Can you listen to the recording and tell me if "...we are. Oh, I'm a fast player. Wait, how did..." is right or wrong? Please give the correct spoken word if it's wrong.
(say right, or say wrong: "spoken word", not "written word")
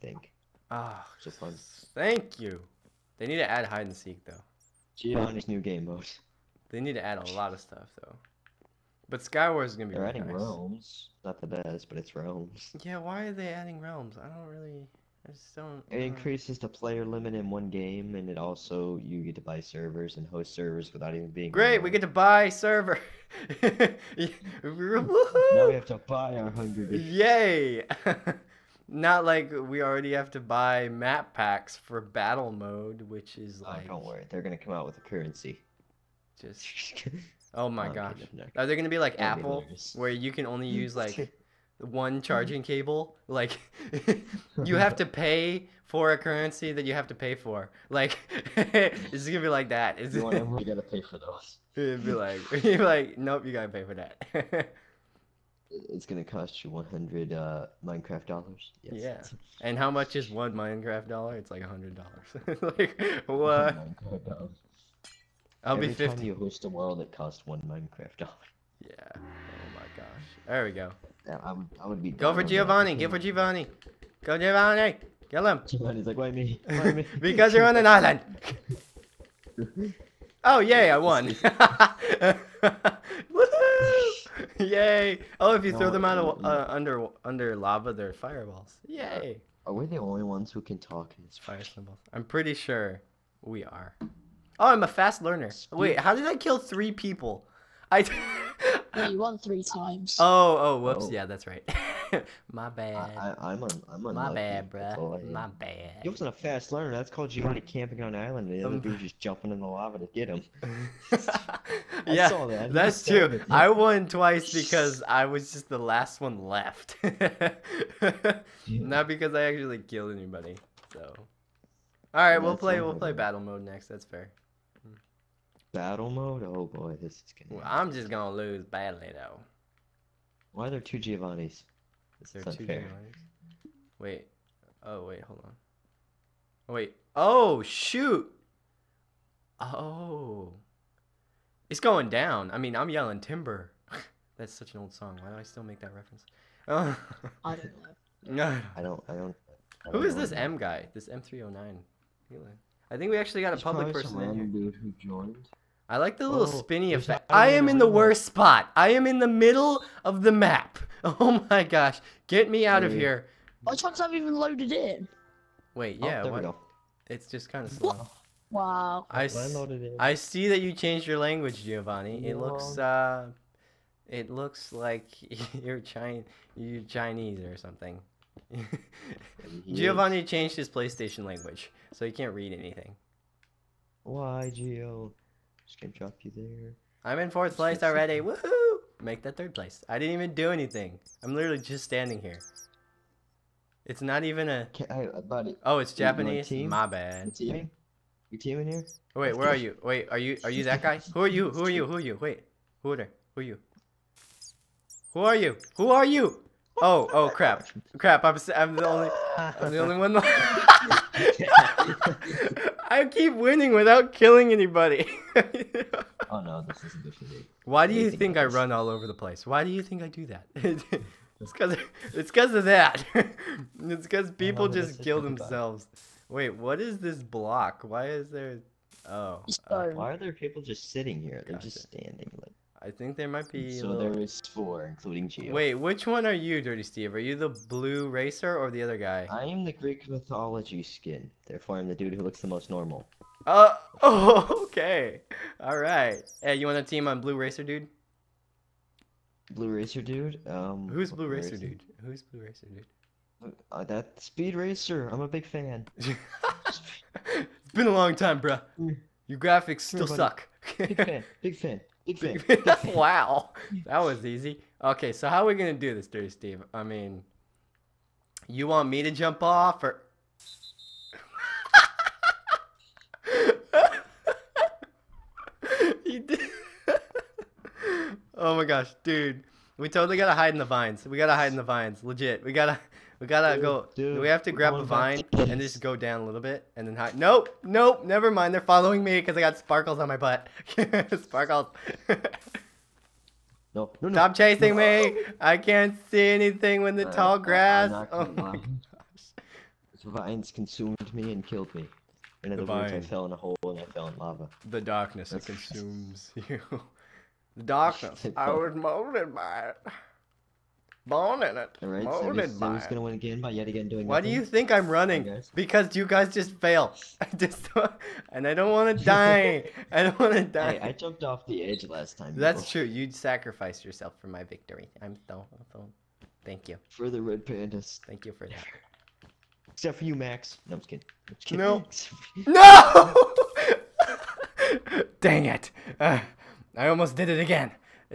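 wrong: "learner", not "player".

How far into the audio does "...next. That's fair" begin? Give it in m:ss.
2:03.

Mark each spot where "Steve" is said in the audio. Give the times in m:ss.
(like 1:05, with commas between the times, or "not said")
3:56, 4:26.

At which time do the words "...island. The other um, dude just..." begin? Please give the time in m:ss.
1:48.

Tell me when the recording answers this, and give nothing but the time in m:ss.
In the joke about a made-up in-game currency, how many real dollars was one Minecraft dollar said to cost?
1:01.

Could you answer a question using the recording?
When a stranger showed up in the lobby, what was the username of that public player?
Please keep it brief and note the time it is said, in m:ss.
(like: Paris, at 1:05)
M309, at 2:30.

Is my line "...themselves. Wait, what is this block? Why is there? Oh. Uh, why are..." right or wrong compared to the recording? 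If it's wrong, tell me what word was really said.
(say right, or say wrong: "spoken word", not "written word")
right.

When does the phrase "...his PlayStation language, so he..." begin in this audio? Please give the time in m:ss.
3:00.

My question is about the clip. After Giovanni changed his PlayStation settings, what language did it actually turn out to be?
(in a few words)
Japanese.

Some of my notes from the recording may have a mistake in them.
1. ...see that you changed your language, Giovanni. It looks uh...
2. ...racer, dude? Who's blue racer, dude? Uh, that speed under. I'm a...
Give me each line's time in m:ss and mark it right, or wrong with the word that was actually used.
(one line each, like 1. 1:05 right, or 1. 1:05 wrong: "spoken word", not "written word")
1. 2:50 right
2. 4:11 wrong: "racer", not "under".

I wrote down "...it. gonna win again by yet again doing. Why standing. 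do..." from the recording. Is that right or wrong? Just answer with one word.
wrong.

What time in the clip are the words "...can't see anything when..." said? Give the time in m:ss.
4:55.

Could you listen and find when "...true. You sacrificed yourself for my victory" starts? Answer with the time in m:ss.
5:22.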